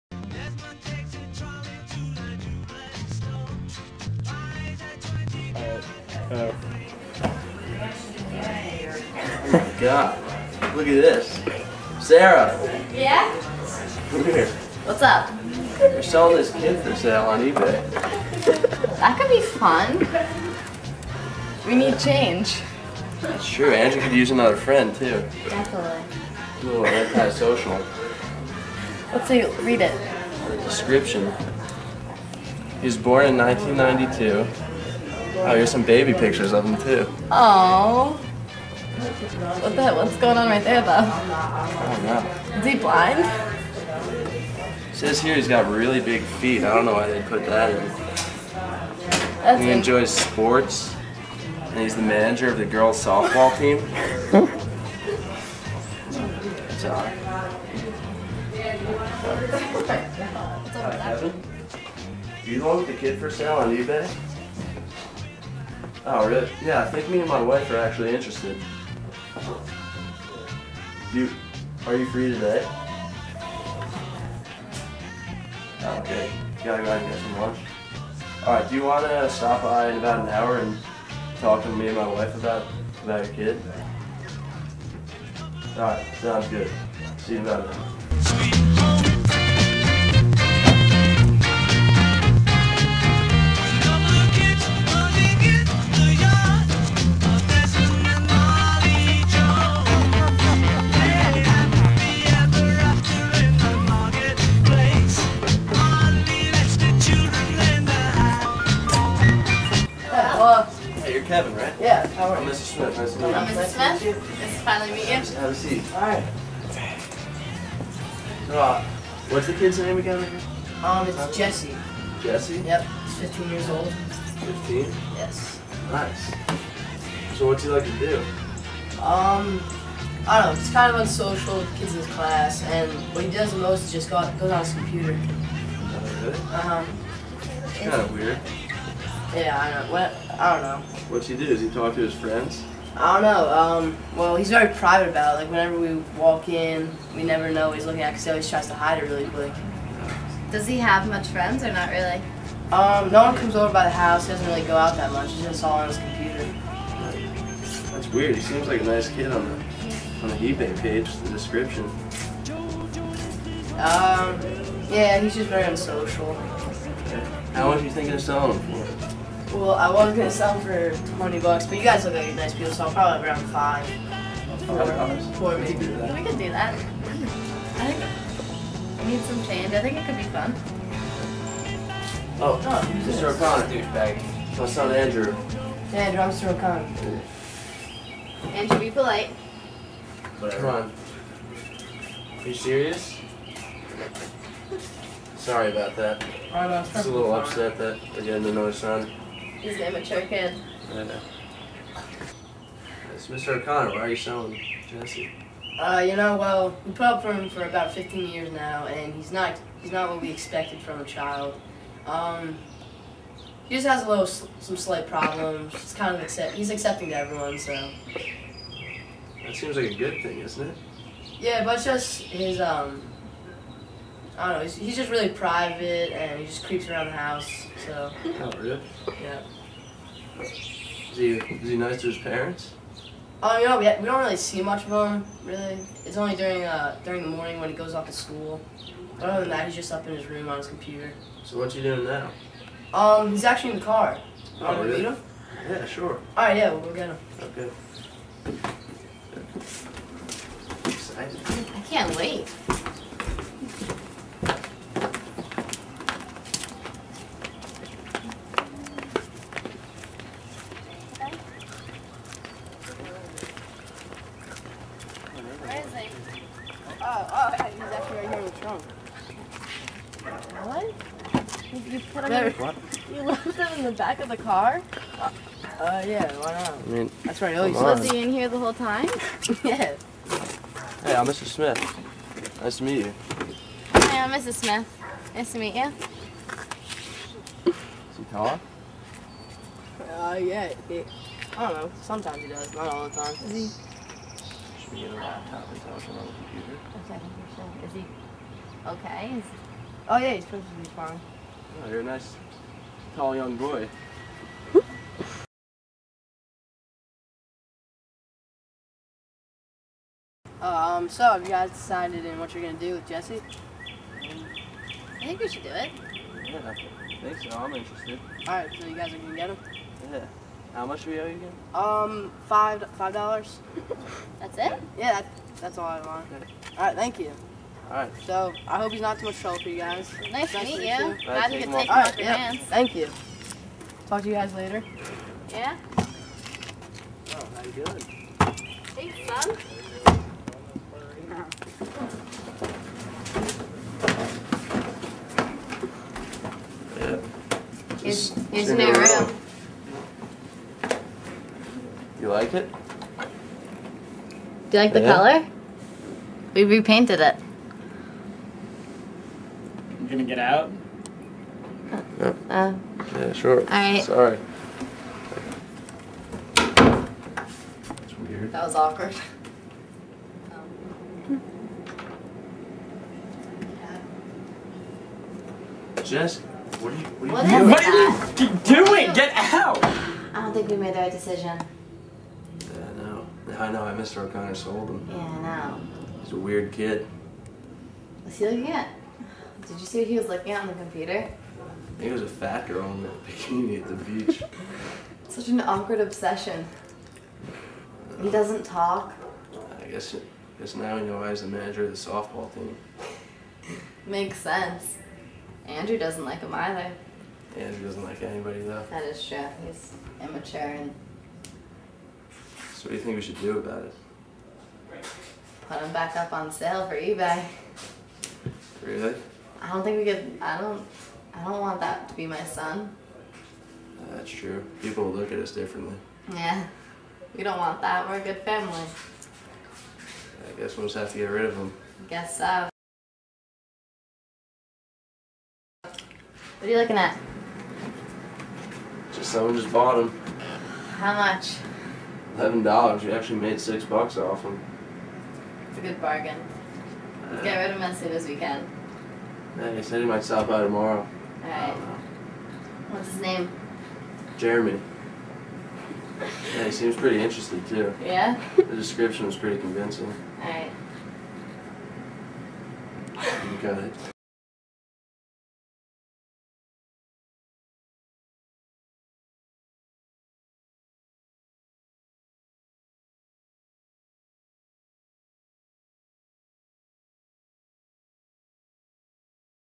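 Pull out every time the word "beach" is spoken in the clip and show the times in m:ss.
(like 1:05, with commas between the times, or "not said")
6:34.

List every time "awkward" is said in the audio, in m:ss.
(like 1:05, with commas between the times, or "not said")
6:08, 6:35.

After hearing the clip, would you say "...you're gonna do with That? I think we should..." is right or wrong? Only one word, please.
wrong.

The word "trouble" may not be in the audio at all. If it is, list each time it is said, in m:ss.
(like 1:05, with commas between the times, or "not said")
5:29.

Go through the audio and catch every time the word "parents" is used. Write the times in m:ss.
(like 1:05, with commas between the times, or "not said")
3:52.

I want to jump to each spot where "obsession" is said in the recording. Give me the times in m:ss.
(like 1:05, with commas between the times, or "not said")
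6:36.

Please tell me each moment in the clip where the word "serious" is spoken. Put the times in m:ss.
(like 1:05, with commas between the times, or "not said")
3:12.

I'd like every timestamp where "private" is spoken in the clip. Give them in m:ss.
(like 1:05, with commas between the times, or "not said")
2:24, 3:45.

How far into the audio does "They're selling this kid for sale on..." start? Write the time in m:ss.
0:15.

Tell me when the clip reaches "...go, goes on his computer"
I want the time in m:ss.
2:14.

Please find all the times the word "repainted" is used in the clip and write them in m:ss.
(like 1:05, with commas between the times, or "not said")
5:56.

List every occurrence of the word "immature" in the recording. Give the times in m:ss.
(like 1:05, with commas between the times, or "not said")
3:19, 6:50.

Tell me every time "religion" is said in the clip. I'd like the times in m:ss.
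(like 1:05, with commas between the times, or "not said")
not said.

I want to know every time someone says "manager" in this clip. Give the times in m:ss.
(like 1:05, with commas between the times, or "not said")
0:52, 6:41.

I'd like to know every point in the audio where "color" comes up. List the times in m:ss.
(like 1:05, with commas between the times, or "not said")
5:55.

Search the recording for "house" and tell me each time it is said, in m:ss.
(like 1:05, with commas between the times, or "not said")
2:33, 3:47.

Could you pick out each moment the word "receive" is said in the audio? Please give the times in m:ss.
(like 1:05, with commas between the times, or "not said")
not said.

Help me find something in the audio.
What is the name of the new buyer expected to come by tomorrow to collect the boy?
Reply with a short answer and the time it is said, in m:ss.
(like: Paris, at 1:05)
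Jeremy, at 7:34.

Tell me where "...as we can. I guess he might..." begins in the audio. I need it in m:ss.
7:28.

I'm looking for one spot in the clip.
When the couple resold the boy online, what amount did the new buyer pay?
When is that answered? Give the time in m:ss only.
7:22.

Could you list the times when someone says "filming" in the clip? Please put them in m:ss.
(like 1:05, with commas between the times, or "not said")
not said.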